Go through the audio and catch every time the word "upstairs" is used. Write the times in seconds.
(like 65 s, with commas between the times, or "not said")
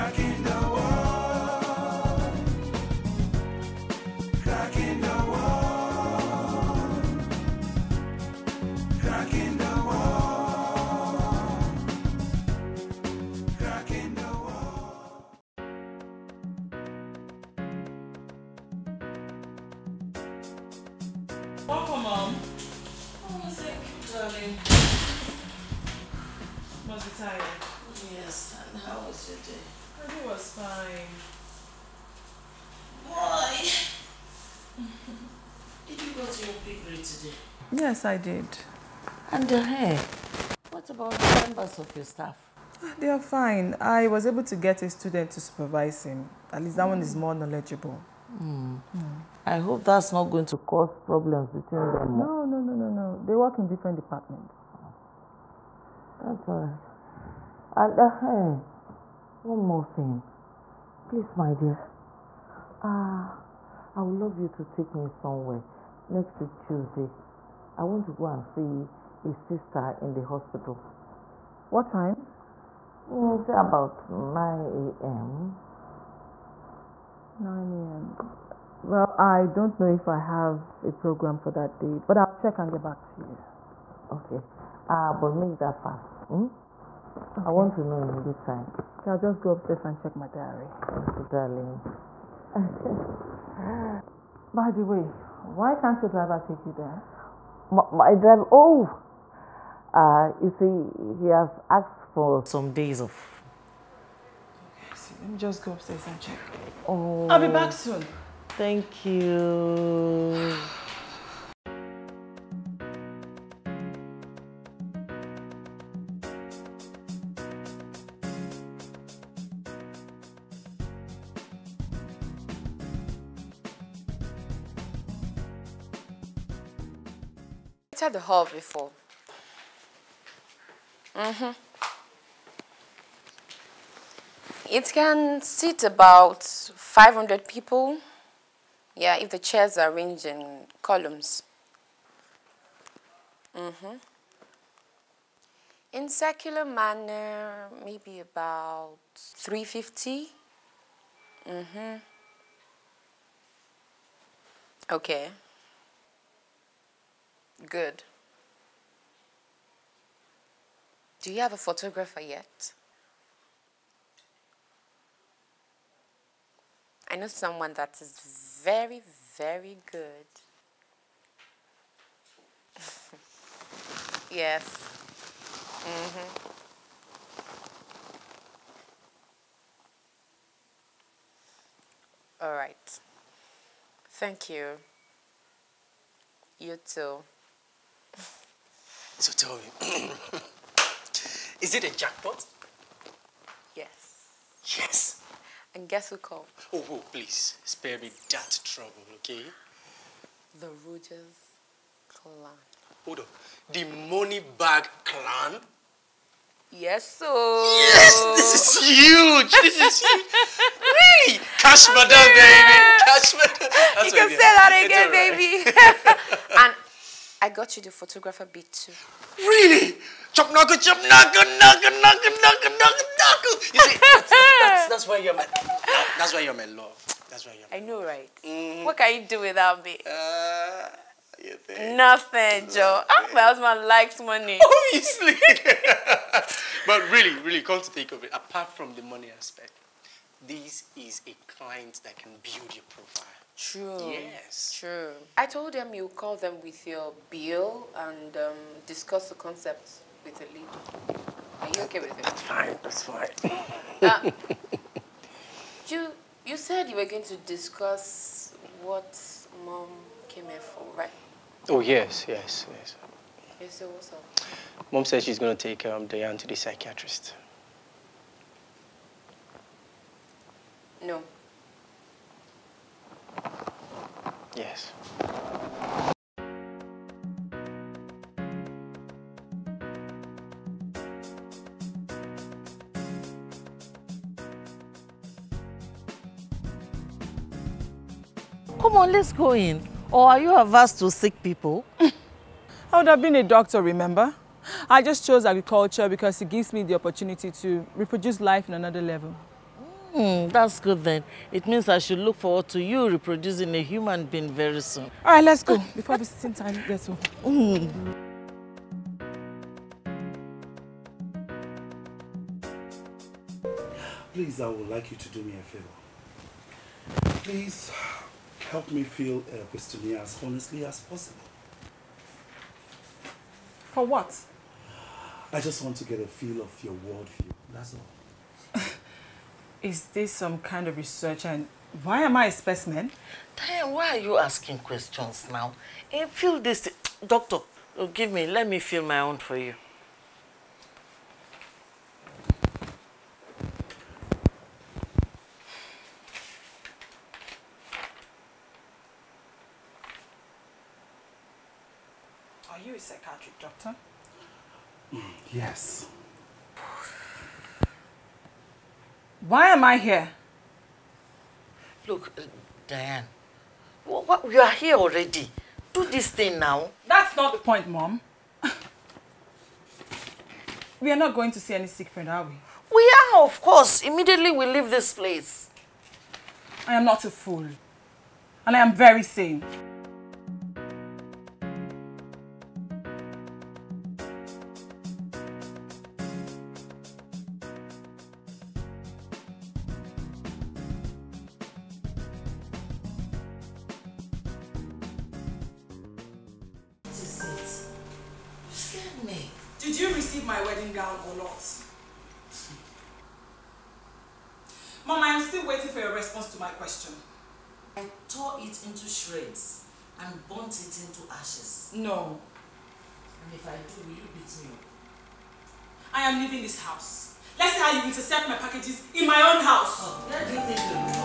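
89 s, 105 s.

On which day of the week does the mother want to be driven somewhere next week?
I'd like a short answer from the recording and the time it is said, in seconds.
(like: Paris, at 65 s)
Tuesday, at 66 s.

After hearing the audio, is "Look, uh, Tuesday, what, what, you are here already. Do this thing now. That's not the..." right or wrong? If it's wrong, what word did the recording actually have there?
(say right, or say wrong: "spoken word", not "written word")
wrong: "Diane", not "Tuesday".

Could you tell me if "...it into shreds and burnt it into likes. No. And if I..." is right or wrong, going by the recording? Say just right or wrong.
wrong.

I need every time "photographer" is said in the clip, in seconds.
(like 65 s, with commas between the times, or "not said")
161 s, 217 s.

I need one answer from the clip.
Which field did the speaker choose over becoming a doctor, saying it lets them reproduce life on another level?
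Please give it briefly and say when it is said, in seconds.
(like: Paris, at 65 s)
Agriculture, at 295 s.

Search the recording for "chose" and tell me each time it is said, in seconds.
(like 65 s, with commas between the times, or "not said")
295 s.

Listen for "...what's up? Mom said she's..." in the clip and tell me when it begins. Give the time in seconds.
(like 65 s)
263 s.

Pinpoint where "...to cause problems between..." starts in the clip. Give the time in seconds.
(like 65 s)
50 s.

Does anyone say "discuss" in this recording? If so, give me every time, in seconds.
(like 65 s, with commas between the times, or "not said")
248 s, 257 s.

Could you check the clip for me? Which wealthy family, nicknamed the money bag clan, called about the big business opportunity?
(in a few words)
The Rogers clan.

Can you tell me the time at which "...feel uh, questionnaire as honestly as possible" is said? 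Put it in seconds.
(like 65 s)
319 s.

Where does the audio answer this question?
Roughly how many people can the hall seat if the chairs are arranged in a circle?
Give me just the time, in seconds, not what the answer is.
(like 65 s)
149 s.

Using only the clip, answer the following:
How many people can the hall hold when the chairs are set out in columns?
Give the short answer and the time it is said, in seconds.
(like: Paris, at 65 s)
500, at 136 s.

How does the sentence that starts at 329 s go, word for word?
Is this some kind of research and why am I a specimen?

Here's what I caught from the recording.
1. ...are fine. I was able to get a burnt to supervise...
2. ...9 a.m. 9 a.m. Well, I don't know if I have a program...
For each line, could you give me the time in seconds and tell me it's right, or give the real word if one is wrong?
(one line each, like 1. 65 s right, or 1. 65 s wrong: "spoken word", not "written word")
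1. 43 s wrong: "student", not "burnt"
2. 74 s right.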